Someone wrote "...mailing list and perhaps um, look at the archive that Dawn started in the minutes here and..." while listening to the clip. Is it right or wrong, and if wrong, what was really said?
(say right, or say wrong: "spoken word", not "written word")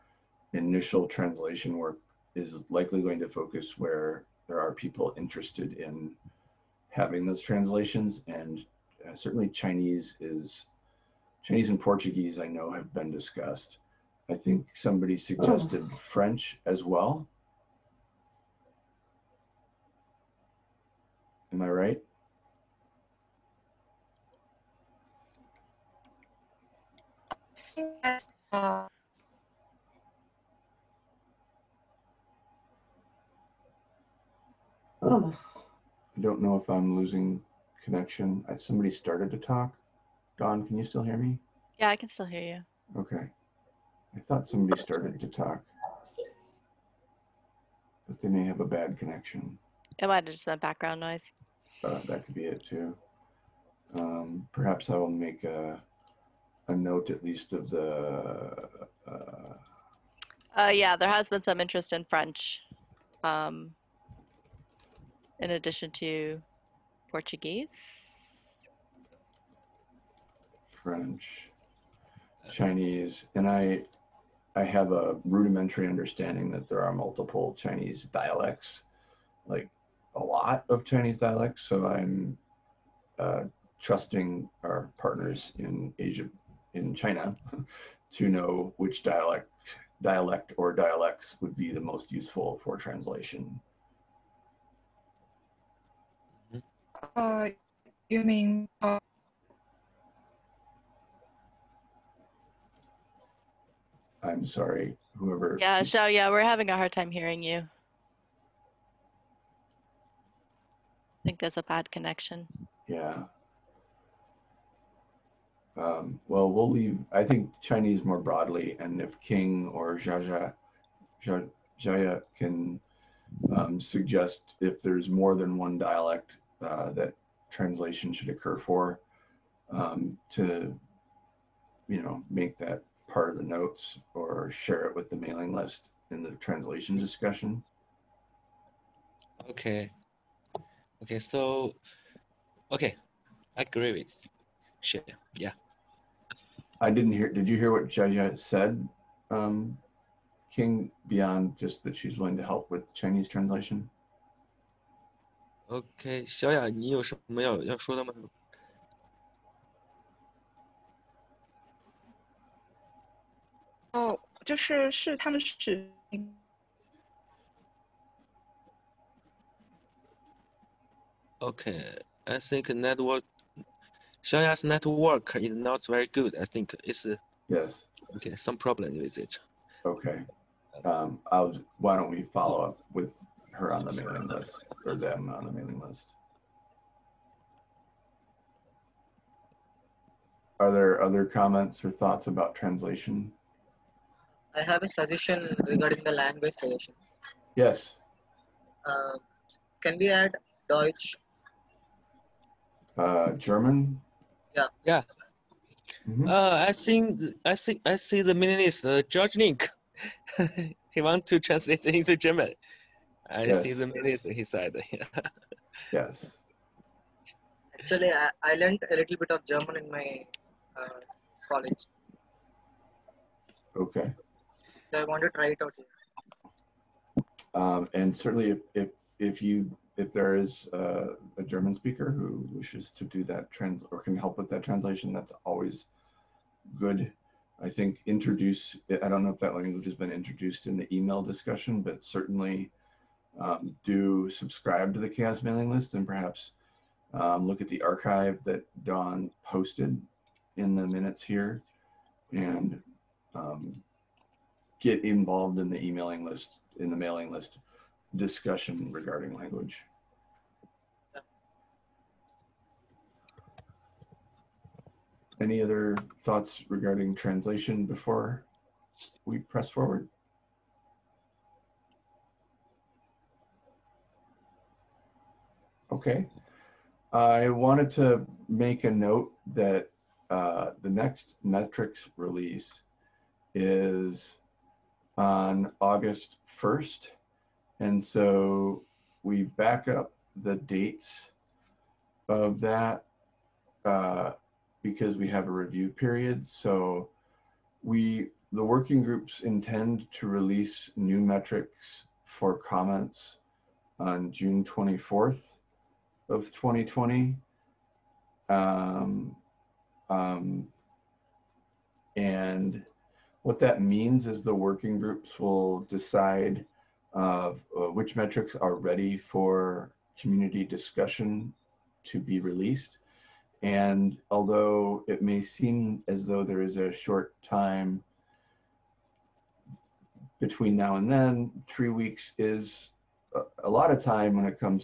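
wrong: "posted", not "started".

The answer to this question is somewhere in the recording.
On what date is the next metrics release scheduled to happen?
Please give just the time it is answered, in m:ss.
4:45.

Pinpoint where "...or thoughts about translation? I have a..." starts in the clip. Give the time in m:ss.
3:11.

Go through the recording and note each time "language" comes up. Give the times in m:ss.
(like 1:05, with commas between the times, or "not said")
3:16, 3:59, 4:19.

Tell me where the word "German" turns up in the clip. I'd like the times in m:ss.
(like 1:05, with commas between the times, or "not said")
3:23, 3:32, 3:39, 3:51.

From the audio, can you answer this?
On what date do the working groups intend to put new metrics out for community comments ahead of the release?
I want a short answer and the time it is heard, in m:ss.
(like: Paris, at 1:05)
June 24th, at 5:04.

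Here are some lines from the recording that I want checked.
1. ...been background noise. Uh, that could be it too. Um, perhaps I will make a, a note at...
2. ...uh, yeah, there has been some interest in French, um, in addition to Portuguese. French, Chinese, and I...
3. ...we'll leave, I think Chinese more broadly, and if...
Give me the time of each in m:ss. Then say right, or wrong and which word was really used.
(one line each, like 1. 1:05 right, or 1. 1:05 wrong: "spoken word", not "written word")
1. 0:50 right
2. 1:00 right
3. 1:56 right.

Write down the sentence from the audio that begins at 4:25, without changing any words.
Any other thoughts regarding translation before we press forward?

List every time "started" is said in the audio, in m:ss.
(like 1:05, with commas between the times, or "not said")
0:38, 0:44.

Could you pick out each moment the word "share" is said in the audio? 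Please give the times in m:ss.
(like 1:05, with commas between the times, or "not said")
2:14, 2:24.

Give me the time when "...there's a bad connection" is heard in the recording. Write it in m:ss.
1:51.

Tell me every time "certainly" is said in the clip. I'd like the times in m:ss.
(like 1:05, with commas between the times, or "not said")
0:09, 3:48, 4:02.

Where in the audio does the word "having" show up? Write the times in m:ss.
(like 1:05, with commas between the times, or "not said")
0:06, 1:46.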